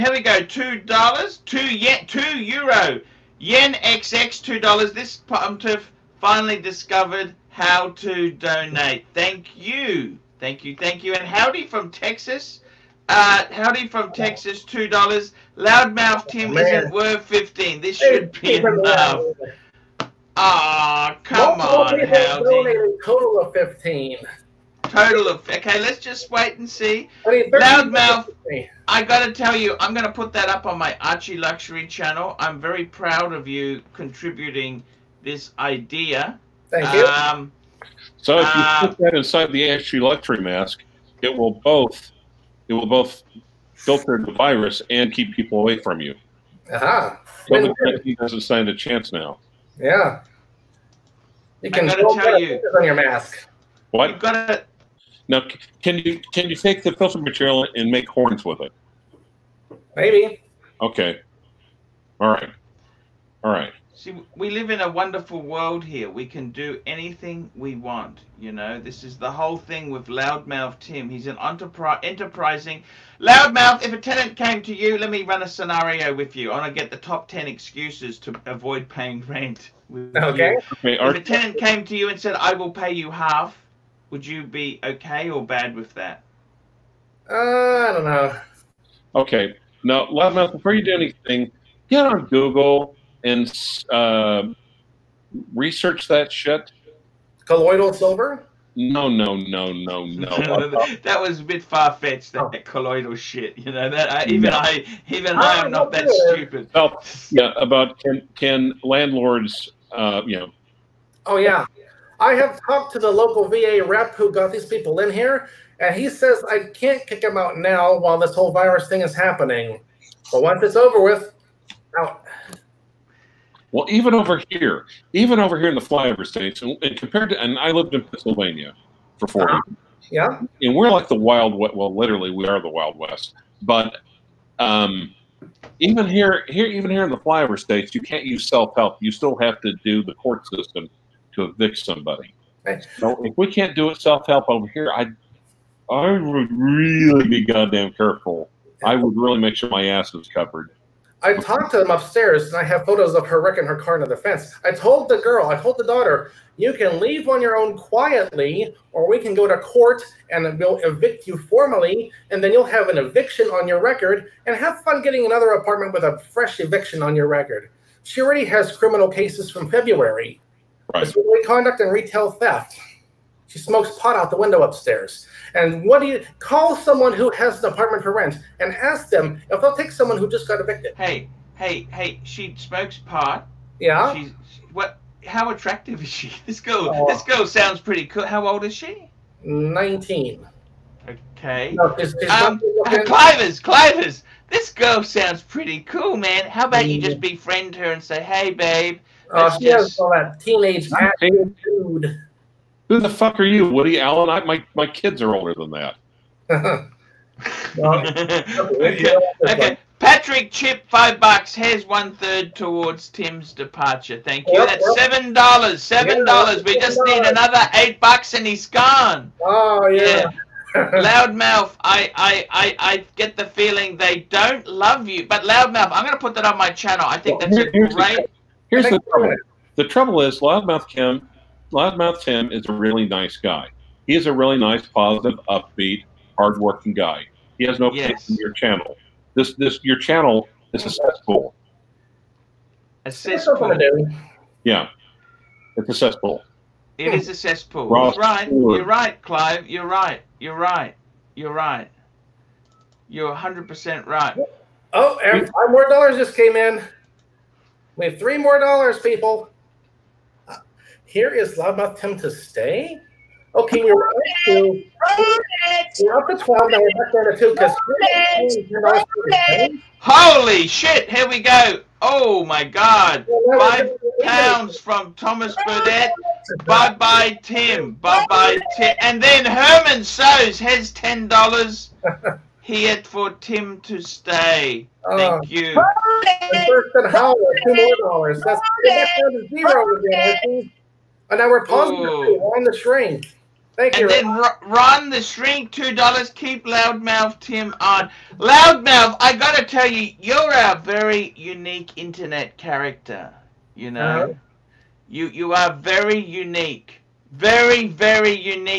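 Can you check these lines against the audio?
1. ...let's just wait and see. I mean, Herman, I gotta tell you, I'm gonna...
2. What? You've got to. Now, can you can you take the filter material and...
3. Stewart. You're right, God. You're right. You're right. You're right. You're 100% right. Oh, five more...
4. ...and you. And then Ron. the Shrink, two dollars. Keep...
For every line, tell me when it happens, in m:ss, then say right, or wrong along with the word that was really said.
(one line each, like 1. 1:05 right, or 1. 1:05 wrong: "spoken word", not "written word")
1. 0:25 wrong: "Loudmouth", not "Herman"
2. 0:53 right
3. 4:08 wrong: "Clive", not "God"
4. 4:53 right.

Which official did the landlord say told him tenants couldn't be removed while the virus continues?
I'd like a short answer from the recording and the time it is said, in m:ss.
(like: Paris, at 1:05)
VA rep, at 1:53.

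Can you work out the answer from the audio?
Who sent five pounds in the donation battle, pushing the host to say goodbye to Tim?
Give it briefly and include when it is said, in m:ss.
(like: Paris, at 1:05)
Thomas Burdett, at 4:35.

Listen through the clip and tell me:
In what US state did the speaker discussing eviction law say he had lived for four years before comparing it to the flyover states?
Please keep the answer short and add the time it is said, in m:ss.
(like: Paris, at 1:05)
Pennsylvania, at 2:08.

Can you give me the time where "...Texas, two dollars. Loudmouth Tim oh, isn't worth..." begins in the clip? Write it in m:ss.
0:14.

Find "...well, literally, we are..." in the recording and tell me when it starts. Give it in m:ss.
2:11.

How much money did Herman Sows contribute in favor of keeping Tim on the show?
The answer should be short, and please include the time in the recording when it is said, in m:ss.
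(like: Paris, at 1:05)
$10, at 4:40.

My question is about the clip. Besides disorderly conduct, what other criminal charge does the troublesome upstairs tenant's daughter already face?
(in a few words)
Retail theft.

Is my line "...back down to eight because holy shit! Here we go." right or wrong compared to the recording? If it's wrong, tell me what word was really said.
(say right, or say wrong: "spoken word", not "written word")
wrong: "two", not "eight".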